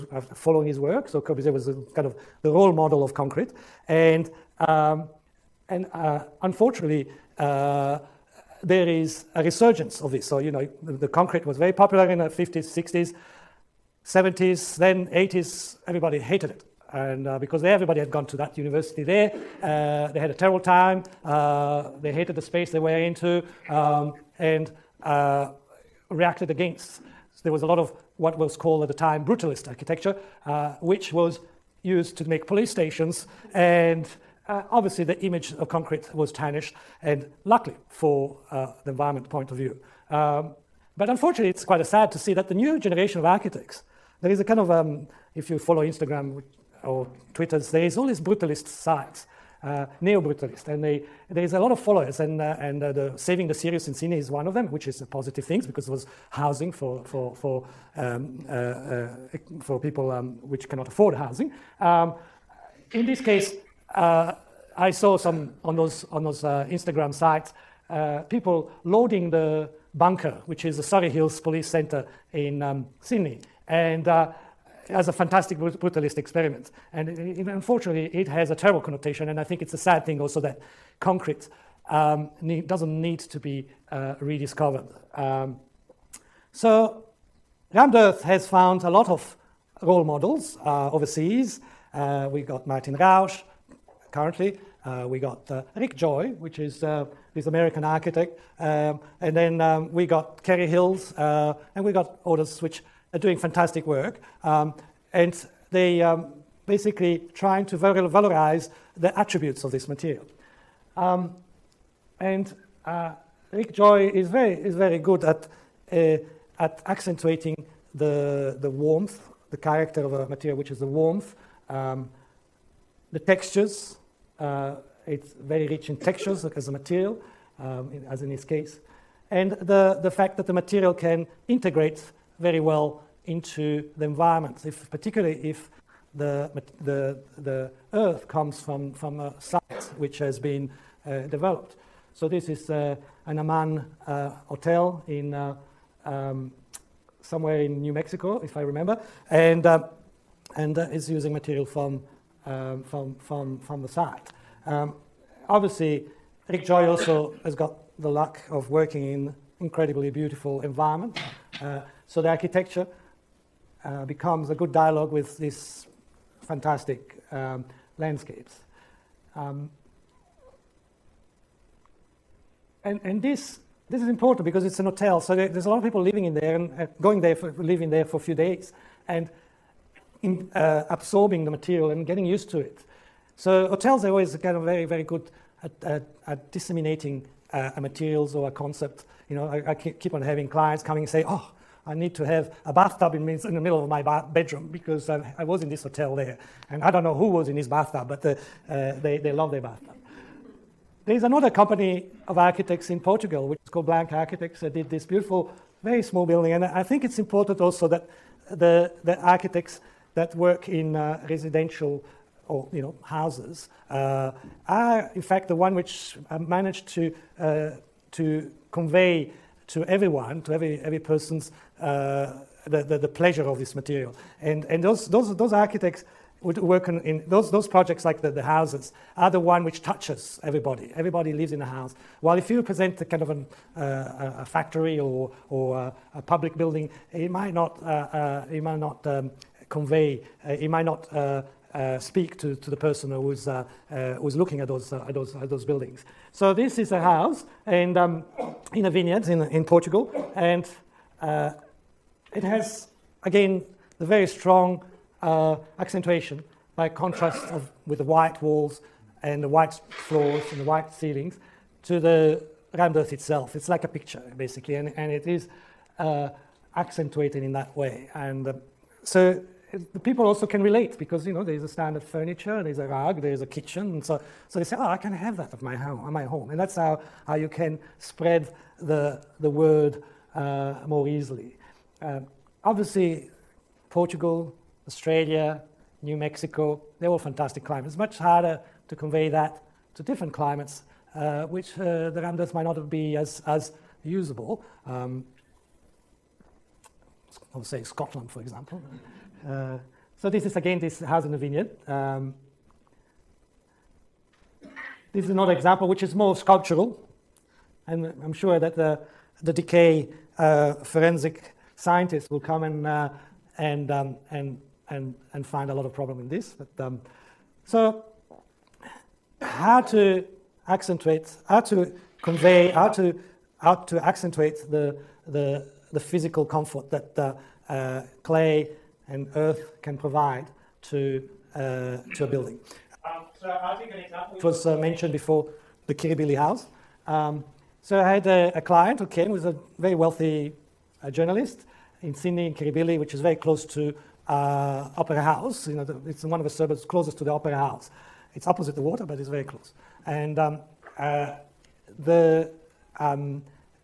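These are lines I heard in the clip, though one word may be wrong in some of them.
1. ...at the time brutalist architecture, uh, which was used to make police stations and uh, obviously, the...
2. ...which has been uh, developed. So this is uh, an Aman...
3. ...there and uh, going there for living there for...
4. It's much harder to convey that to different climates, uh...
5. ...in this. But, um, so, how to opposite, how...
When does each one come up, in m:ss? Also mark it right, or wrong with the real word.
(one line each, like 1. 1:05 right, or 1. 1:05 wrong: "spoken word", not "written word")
1. 0:28 right
2. 2:19 right
3. 2:56 right
4. 4:47 right
5. 5:16 wrong: "accentuate", not "opposite".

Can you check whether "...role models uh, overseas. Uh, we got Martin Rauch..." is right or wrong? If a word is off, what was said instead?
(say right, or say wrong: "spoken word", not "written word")
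right.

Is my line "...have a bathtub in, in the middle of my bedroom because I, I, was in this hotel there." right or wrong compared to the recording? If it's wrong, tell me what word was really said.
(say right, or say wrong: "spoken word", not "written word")
right.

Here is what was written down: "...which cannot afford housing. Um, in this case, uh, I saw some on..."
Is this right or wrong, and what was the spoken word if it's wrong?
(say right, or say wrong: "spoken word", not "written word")
right.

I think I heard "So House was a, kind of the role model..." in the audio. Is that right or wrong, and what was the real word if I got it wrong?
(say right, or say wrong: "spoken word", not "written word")
wrong: "Corbusier", not "House".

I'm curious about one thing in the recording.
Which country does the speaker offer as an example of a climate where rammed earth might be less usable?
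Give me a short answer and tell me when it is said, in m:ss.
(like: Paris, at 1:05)
Scotland, at 4:57.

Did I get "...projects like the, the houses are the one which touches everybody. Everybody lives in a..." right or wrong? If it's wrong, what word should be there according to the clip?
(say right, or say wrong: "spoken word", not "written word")
right.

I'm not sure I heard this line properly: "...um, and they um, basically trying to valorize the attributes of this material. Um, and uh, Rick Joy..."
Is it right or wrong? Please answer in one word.
right.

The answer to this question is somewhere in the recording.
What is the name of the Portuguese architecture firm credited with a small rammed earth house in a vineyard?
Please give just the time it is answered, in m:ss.
3:23.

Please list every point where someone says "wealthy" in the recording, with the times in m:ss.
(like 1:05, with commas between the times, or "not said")
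5:39.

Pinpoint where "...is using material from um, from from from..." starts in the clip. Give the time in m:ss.
2:30.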